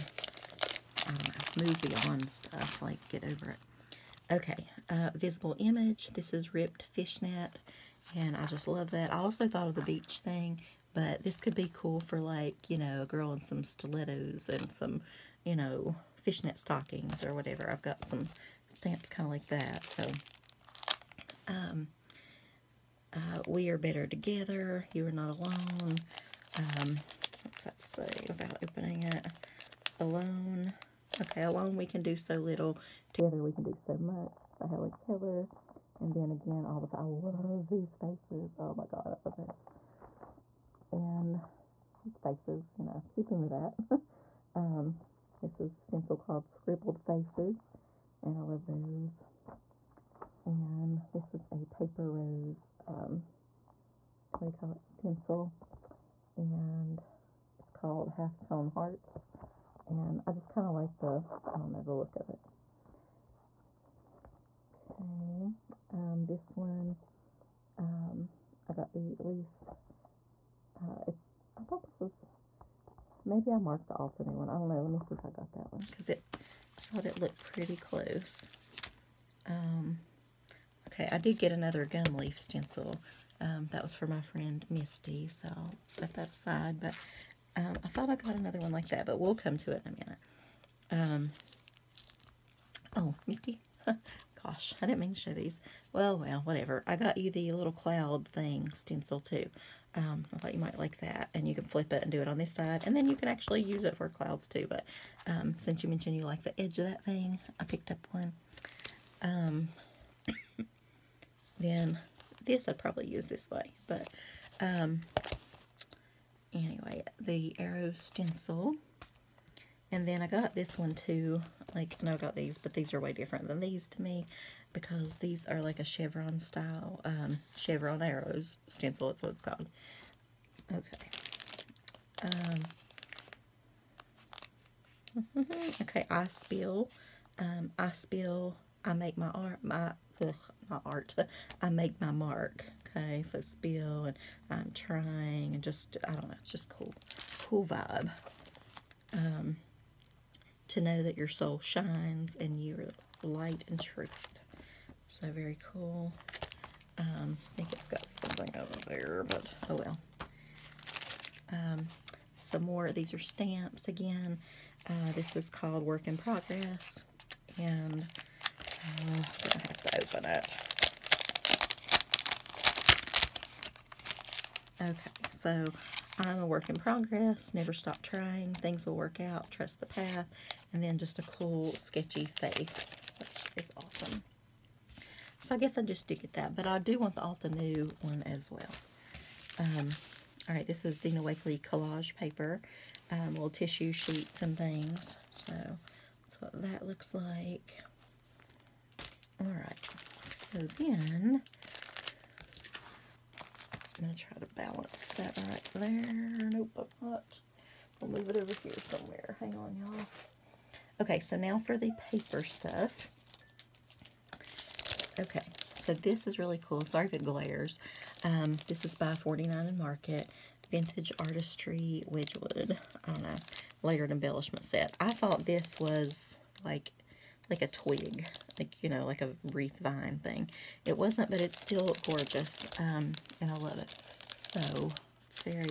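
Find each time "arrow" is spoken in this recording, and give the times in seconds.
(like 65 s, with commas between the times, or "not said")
117 s, 128 s.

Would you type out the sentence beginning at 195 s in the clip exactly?
So that's what that looks like.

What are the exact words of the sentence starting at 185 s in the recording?
So I guess I just stick get that, but I do want the Altenew one as well.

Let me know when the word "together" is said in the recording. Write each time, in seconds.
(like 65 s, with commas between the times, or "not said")
24 s, 33 s.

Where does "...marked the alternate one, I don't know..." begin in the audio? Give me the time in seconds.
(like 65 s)
73 s.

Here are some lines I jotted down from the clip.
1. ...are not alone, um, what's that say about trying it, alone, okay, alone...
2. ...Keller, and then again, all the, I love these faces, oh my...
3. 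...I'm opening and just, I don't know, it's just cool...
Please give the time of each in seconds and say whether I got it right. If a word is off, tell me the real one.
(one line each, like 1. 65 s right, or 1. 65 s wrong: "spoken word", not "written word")
1. 25 s wrong: "opening", not "trying"
2. 34 s right
3. 144 s wrong: "trying", not "opening".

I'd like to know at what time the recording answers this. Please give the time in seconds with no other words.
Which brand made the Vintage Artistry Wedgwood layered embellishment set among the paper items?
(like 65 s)
219 s.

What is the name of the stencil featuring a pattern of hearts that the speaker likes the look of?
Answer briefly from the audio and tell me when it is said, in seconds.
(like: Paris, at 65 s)
Half Tone Hearts, at 58 s.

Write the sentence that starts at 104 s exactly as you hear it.
But um, since you mentioned you like the edge of that thing, I picked up one.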